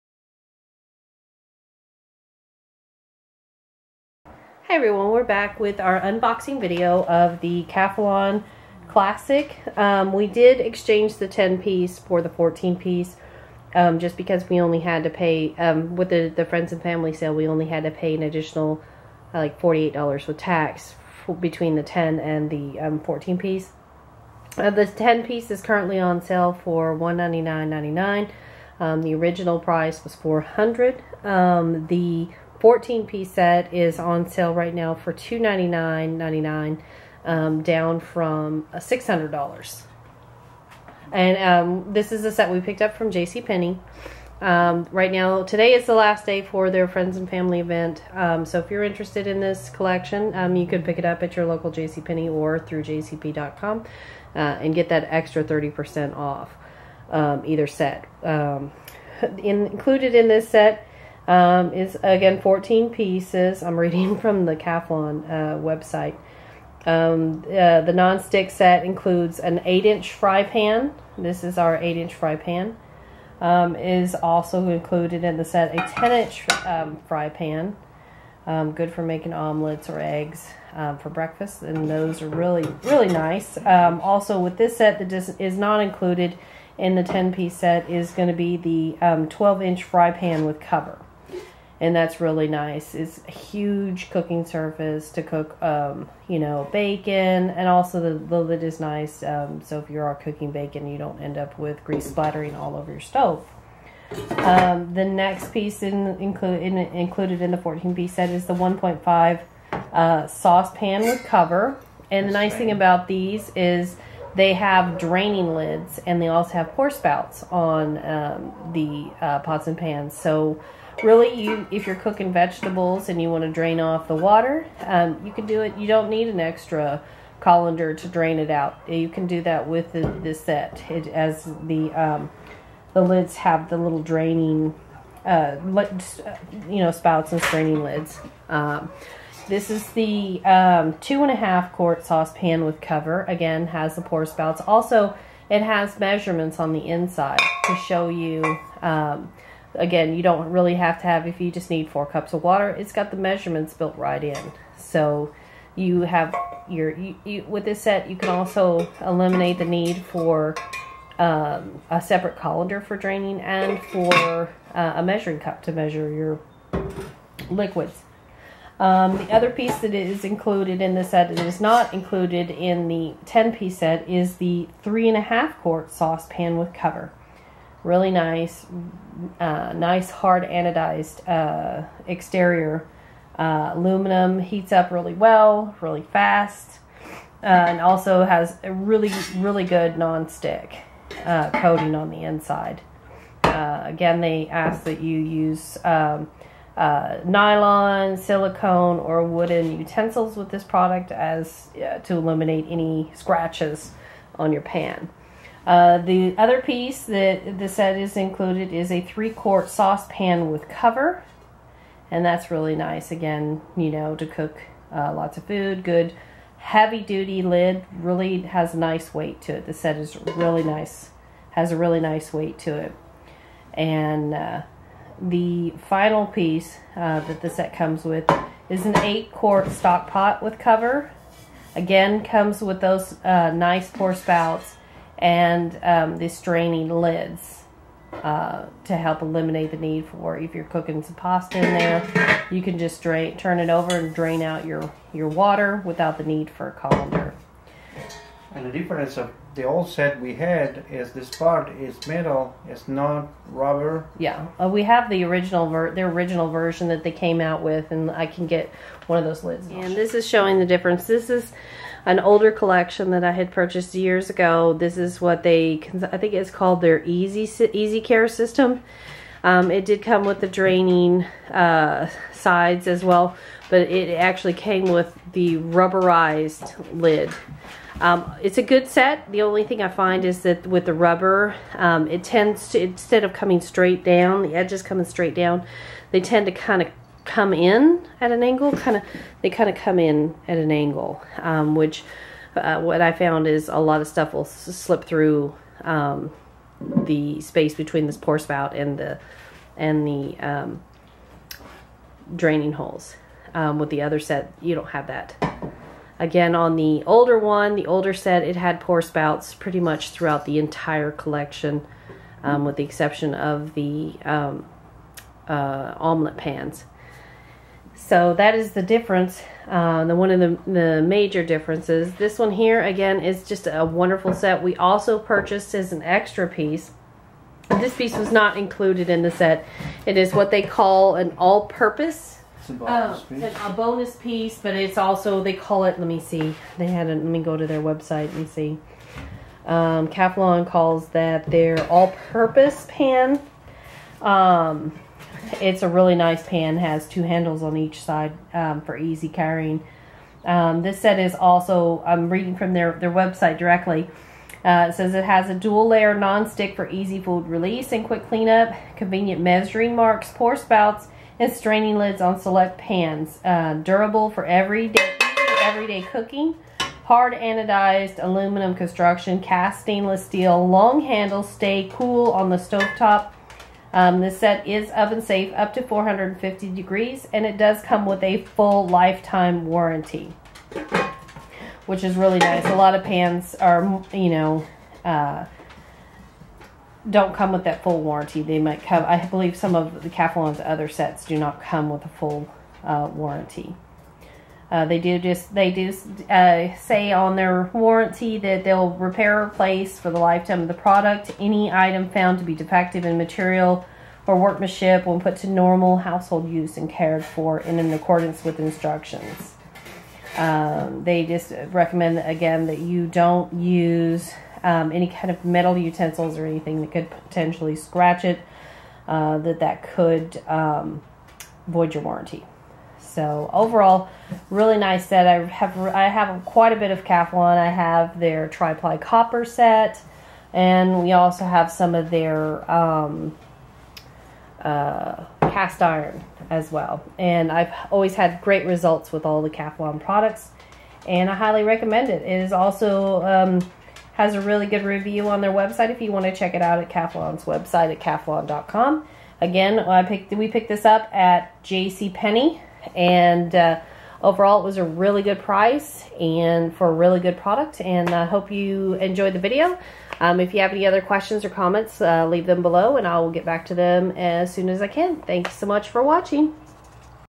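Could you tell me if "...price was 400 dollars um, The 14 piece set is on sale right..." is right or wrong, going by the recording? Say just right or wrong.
right.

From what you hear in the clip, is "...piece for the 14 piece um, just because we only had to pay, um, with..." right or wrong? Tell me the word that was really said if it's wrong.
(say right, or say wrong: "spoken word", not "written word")
right.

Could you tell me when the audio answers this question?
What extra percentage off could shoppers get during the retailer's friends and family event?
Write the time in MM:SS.
00:55.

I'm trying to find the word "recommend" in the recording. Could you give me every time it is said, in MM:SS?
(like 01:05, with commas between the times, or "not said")
06:51, 07:21.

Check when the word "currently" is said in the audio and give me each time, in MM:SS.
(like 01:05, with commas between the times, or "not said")
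00:25.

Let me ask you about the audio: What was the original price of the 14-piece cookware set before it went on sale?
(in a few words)
$600.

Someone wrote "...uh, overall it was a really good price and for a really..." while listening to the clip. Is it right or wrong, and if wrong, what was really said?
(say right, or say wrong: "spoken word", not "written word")
right.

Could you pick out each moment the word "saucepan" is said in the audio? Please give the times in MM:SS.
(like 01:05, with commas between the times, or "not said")
01:50, 02:22, 02:55, 03:29.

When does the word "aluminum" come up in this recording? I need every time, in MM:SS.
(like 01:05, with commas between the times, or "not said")
03:03, 06:08.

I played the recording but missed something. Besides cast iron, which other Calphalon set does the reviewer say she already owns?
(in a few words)
Triply copper.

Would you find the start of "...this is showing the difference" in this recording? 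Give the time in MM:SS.
04:19.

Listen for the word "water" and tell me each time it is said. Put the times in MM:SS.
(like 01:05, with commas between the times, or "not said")
02:04, 02:32, 04:05.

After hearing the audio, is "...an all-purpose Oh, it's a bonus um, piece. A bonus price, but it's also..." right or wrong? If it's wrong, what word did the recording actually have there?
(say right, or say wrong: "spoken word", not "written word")
wrong: "piece", not "price".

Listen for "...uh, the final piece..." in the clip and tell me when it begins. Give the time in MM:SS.
03:44.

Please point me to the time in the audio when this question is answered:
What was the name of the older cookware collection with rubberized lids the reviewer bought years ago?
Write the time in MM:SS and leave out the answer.
04:27.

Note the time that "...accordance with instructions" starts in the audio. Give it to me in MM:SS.
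06:47.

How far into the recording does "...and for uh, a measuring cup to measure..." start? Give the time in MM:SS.
02:43.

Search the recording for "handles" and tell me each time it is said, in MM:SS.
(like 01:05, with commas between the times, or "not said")
05:47, 06:11.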